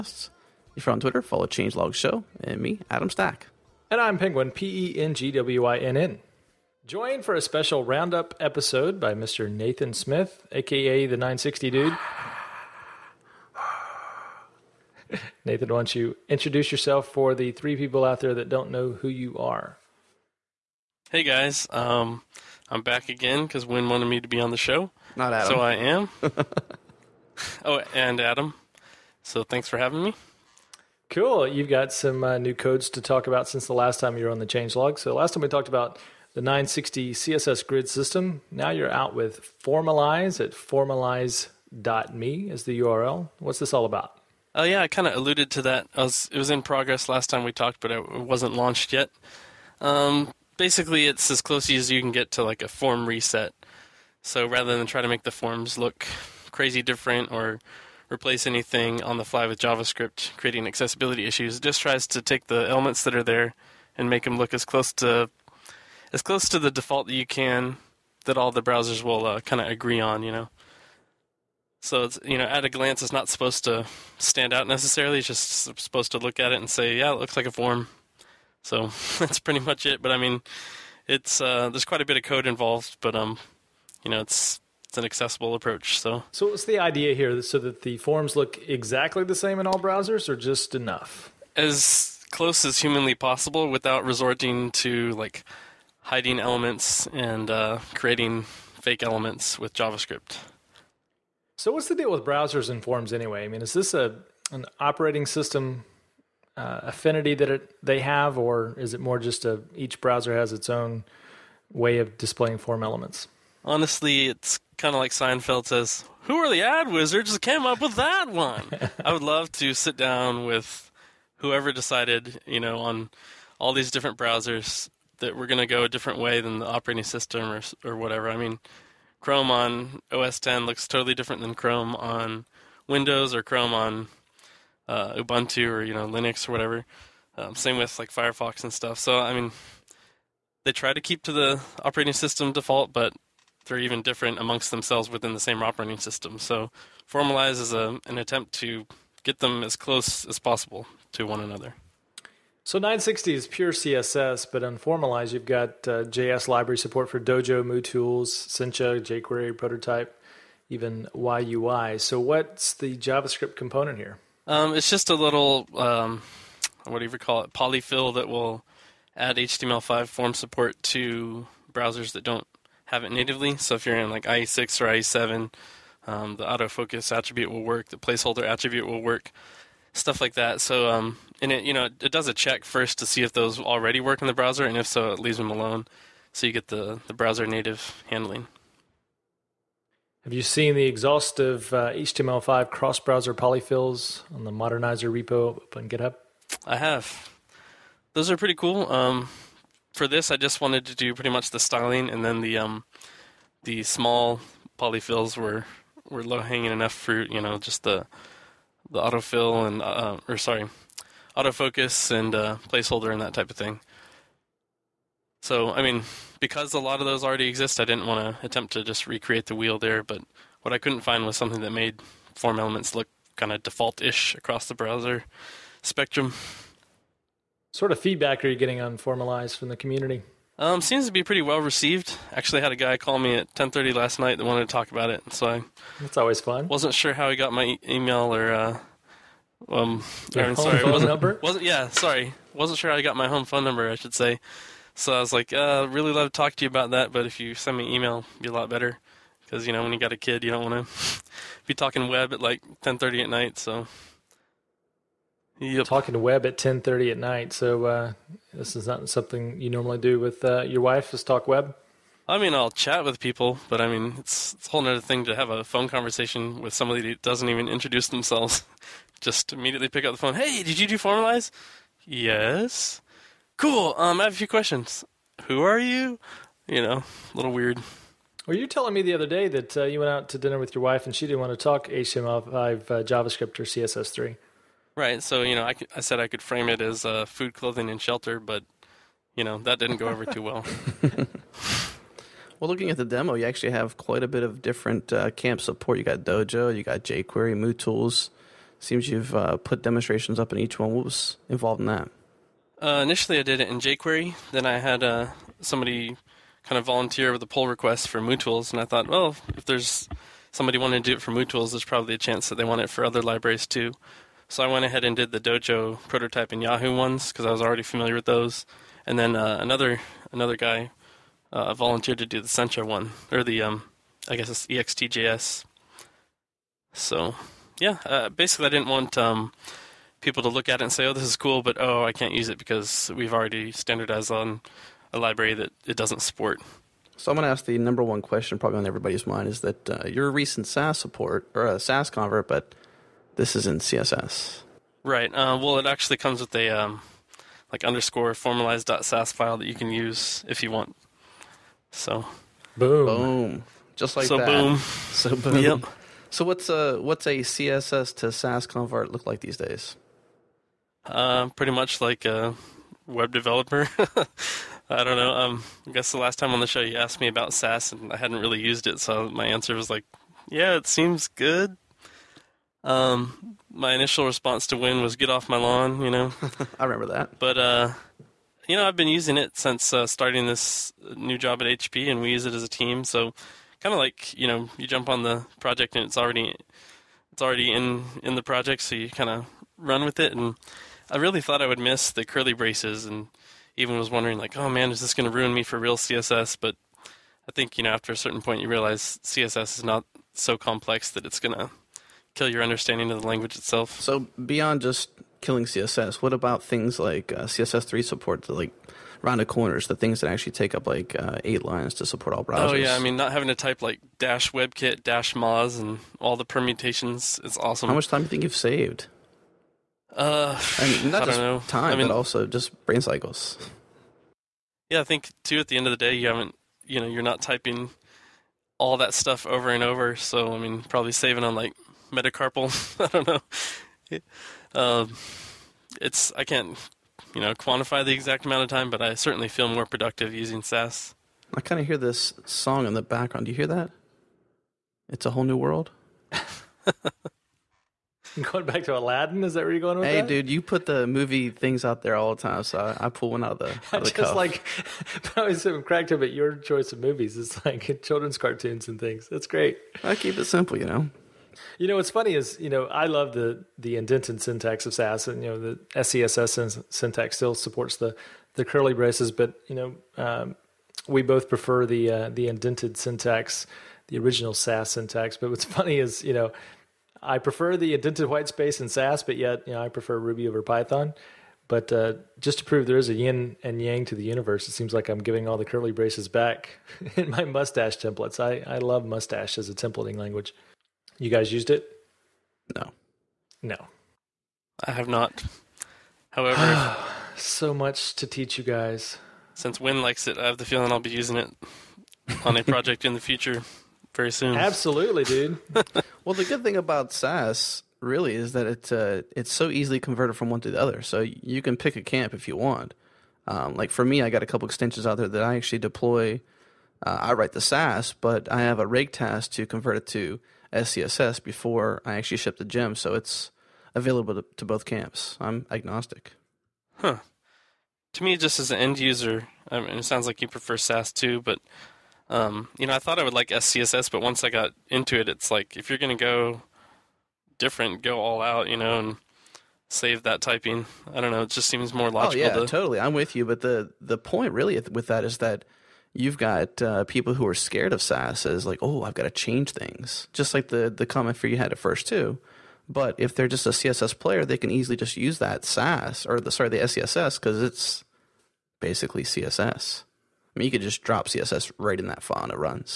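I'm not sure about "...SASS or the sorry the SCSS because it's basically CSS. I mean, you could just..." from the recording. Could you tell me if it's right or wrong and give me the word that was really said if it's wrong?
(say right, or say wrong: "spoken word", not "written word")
right.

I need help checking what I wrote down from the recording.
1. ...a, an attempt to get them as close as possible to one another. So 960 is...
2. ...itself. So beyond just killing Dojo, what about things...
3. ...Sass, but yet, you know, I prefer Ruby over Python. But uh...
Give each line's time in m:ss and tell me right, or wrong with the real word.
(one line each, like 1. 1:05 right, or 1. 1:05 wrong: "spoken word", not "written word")
1. 2:27 right
2. 6:43 wrong: "CSS", not "Dojo"
3. 7:58 right.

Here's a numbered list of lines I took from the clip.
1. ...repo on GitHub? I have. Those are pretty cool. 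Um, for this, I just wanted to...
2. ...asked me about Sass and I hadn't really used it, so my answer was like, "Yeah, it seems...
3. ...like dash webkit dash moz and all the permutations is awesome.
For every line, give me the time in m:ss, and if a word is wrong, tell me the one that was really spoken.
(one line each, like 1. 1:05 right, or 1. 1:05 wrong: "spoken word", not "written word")
1. 3:15 right
2. 6:06 right
3. 6:53 right.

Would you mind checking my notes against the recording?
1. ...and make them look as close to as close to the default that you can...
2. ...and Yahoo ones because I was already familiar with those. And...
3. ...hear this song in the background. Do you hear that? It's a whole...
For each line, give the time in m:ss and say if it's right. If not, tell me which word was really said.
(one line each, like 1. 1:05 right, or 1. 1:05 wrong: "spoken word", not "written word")
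1. 1:03 right
2. 5:16 right
3. 7:21 right.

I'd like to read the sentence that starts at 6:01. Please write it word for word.
Uh, pretty much like a web developer.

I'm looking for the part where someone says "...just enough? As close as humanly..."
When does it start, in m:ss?
1:30.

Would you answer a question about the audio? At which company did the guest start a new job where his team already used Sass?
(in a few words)
HP.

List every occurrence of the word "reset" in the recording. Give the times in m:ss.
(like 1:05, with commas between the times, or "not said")
0:53.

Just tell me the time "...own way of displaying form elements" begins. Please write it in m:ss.
1:50.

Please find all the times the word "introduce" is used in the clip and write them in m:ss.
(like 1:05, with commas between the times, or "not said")
0:16, 4:27.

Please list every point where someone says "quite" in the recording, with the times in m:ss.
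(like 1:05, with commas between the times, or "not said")
1:21, 4:53.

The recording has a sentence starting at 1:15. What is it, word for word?
It's just supposed to look at it and say, yeah, it looks like a form.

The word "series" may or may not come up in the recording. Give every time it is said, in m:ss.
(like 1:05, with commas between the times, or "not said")
not said.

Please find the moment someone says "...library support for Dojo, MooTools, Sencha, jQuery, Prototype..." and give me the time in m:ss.
2:36.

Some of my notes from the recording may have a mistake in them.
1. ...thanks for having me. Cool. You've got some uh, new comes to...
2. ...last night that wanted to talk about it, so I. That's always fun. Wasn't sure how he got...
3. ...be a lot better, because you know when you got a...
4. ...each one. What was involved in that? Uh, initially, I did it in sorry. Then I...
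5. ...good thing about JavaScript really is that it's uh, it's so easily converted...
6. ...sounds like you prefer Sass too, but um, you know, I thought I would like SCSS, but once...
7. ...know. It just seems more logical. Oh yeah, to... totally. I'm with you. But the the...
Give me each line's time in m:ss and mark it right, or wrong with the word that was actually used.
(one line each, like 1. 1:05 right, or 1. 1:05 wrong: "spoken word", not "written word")
1. 0:29 wrong: "codes", not "comes"
2. 3:53 right
3. 4:08 right
4. 5:00 wrong: "jQuery", not "sorry"
5. 8:26 wrong: "Sass", not "JavaScript"
6. 8:50 right
7. 9:01 right.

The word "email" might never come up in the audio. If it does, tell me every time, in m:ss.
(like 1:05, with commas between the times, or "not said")
3:57, 4:07.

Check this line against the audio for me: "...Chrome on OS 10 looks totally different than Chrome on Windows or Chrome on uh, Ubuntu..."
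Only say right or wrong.
right.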